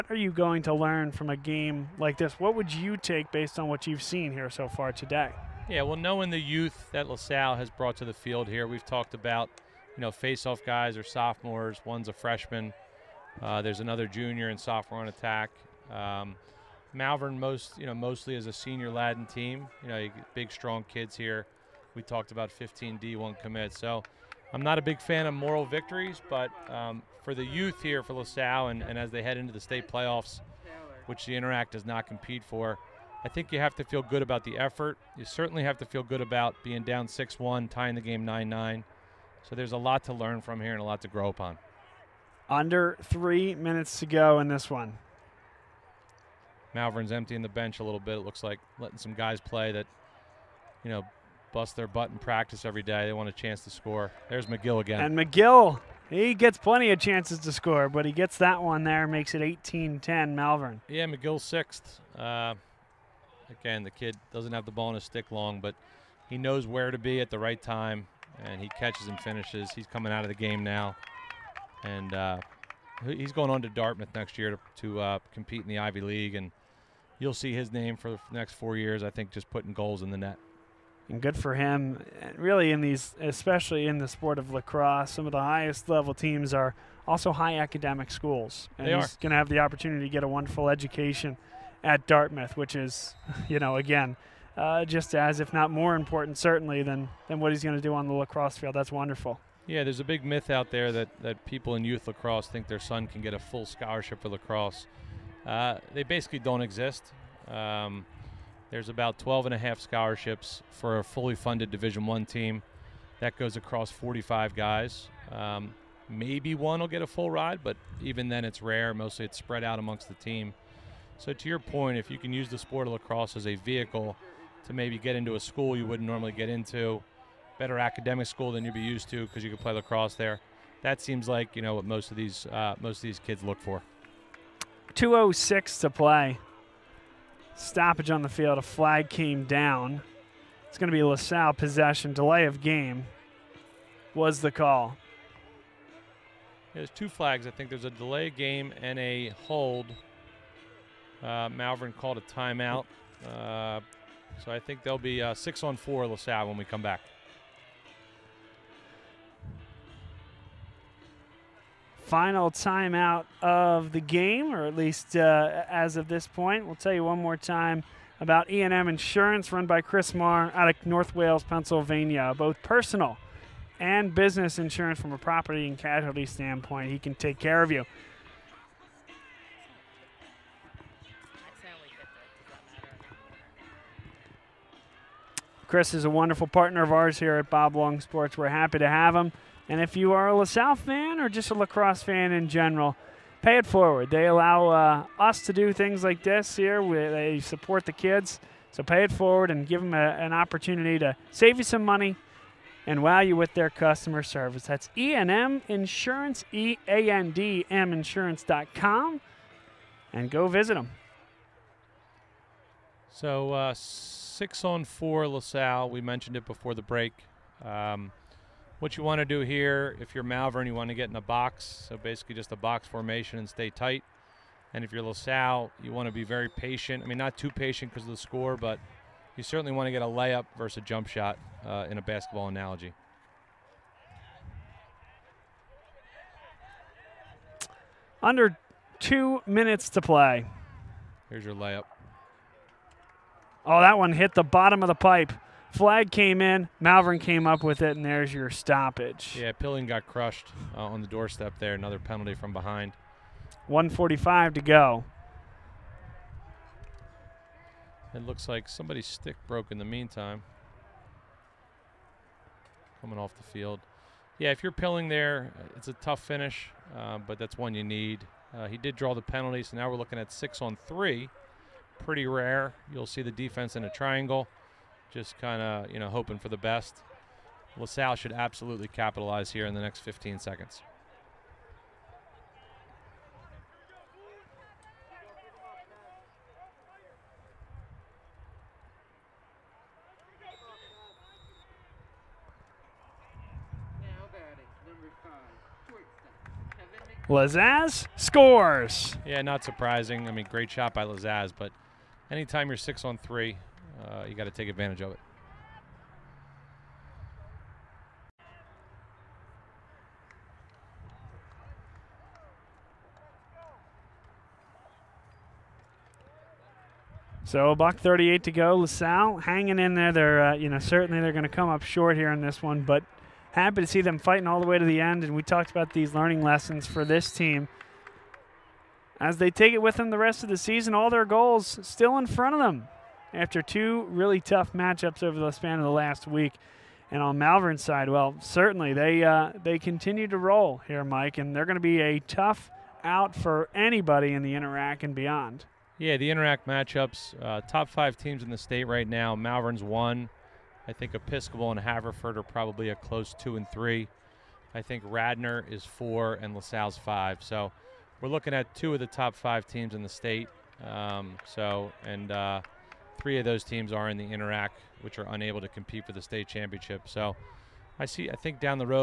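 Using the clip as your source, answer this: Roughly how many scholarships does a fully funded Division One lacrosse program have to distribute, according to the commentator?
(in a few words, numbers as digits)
12.5.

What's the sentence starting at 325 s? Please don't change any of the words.
And we talked about these learning lessons for this team as they take it with them the rest of the season.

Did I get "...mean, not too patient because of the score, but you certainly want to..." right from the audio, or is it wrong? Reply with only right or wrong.
right.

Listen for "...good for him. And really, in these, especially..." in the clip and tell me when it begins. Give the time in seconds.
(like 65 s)
81 s.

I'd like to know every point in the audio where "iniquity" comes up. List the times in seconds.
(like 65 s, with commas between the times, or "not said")
not said.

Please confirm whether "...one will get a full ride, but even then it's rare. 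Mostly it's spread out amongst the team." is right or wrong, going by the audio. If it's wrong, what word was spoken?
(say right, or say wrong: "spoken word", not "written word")
right.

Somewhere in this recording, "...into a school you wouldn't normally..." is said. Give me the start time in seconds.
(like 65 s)
125 s.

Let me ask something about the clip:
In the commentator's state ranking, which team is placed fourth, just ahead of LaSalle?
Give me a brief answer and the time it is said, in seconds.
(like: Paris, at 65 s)
Radnor, at 355 s.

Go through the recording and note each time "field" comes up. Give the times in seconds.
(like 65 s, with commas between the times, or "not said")
8 s, 98 s, 138 s, 263 s.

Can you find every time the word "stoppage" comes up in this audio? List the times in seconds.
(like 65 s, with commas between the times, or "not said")
137 s, 248 s.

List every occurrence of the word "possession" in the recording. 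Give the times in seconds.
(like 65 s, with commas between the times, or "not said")
141 s.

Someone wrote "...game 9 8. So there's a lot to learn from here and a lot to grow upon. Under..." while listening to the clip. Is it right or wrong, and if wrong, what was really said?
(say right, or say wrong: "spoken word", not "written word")
wrong: "9", not "8".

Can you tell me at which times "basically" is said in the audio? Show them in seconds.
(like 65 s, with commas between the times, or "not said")
106 s, 221 s.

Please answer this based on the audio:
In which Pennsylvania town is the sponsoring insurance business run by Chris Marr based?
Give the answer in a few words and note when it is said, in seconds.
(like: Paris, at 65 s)
North Wales, at 170 s.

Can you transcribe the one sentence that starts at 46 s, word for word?
Malvern's emptying the bench a little bit.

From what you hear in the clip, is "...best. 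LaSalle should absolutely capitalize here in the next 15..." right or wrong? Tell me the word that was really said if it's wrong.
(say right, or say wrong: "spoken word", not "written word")
right.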